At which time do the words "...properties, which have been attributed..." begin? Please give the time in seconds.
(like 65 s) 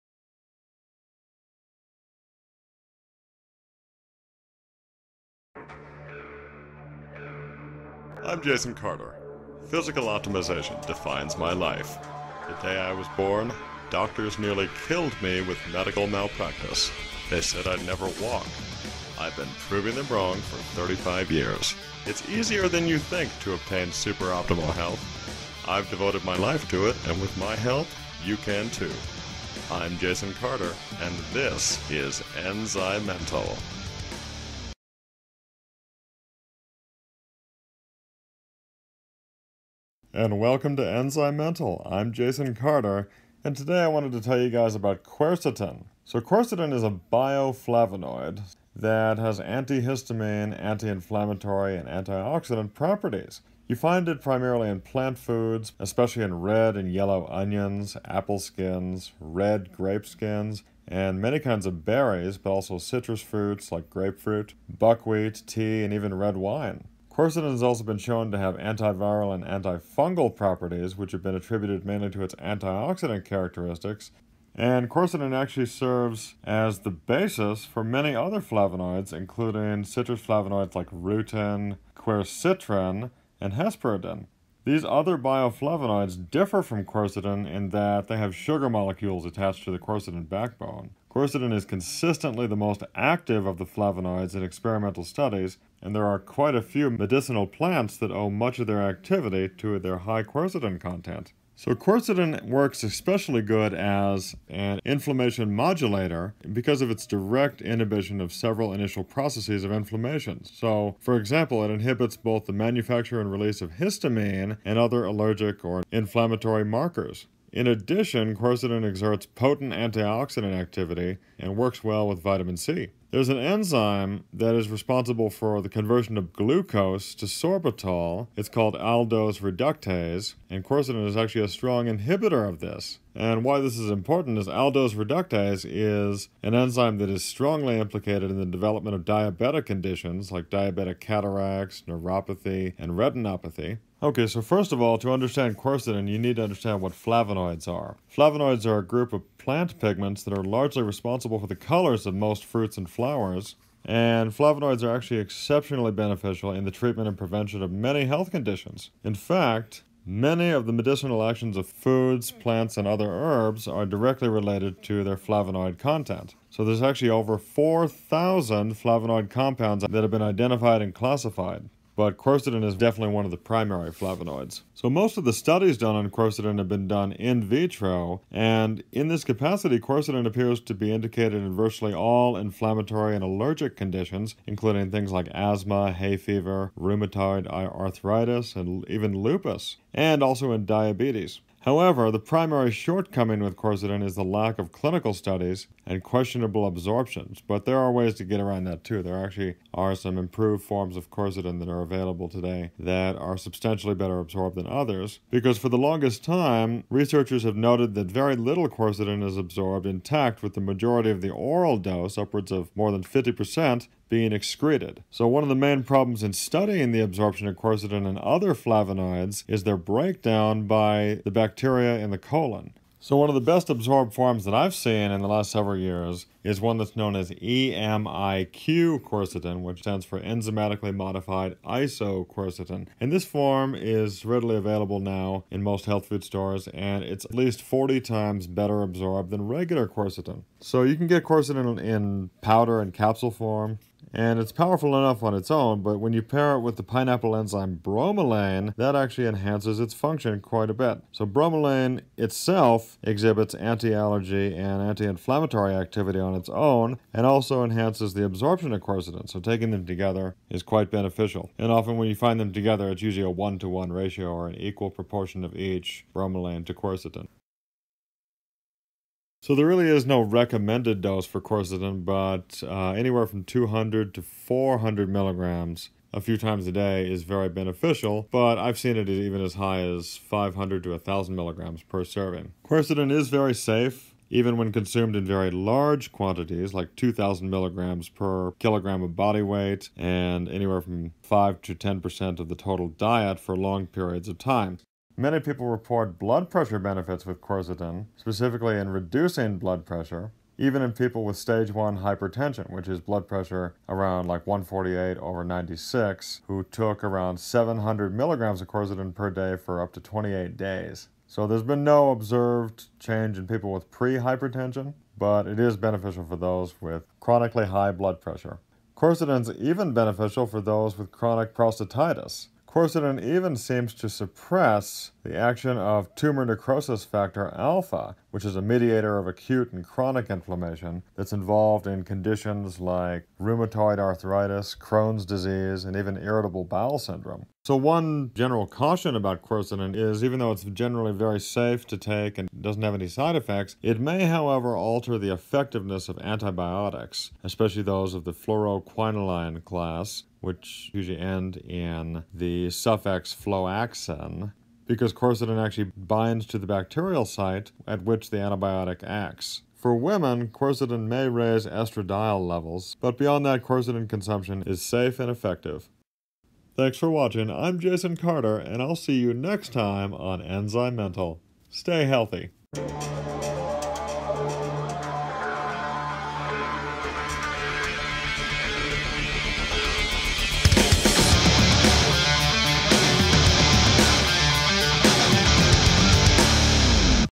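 70 s.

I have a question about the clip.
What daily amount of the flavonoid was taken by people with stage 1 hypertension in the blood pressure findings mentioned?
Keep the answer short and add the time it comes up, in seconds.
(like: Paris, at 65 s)
700 milligrams, at 307 s.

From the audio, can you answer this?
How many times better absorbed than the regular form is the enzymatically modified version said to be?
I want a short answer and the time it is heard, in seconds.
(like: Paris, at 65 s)
40 times, at 237 s.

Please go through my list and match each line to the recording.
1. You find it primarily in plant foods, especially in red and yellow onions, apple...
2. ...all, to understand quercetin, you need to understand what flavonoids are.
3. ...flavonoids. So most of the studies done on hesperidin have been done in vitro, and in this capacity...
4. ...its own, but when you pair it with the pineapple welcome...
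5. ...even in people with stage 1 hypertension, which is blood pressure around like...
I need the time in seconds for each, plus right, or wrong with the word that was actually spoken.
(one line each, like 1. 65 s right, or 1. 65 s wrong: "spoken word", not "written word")
1. 53 s right
2. 144 s right
3. 173 s wrong: "quercetin", not "hesperidin"
4. 245 s wrong: "enzyme", not "welcome"
5. 300 s right.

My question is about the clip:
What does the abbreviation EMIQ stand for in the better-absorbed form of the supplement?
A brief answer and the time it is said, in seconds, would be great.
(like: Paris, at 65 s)
enzymatically modified isoquercetin, at 230 s.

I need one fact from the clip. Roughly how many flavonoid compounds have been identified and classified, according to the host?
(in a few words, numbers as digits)
over 4,000.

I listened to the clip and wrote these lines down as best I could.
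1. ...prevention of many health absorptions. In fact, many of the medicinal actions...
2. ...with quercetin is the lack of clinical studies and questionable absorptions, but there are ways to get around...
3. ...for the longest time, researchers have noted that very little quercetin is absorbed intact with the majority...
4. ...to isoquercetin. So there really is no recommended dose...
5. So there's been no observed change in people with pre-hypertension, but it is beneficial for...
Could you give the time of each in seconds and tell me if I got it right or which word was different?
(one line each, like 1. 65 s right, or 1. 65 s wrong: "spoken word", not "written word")
1. 157 s wrong: "conditions", not "absorptions"
2. 193 s right
3. 205 s right
4. 266 s wrong: "quercetin", not "isoquercetin"
5. 311 s right.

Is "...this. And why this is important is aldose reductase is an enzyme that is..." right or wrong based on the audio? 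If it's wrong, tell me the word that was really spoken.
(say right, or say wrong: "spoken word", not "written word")
right.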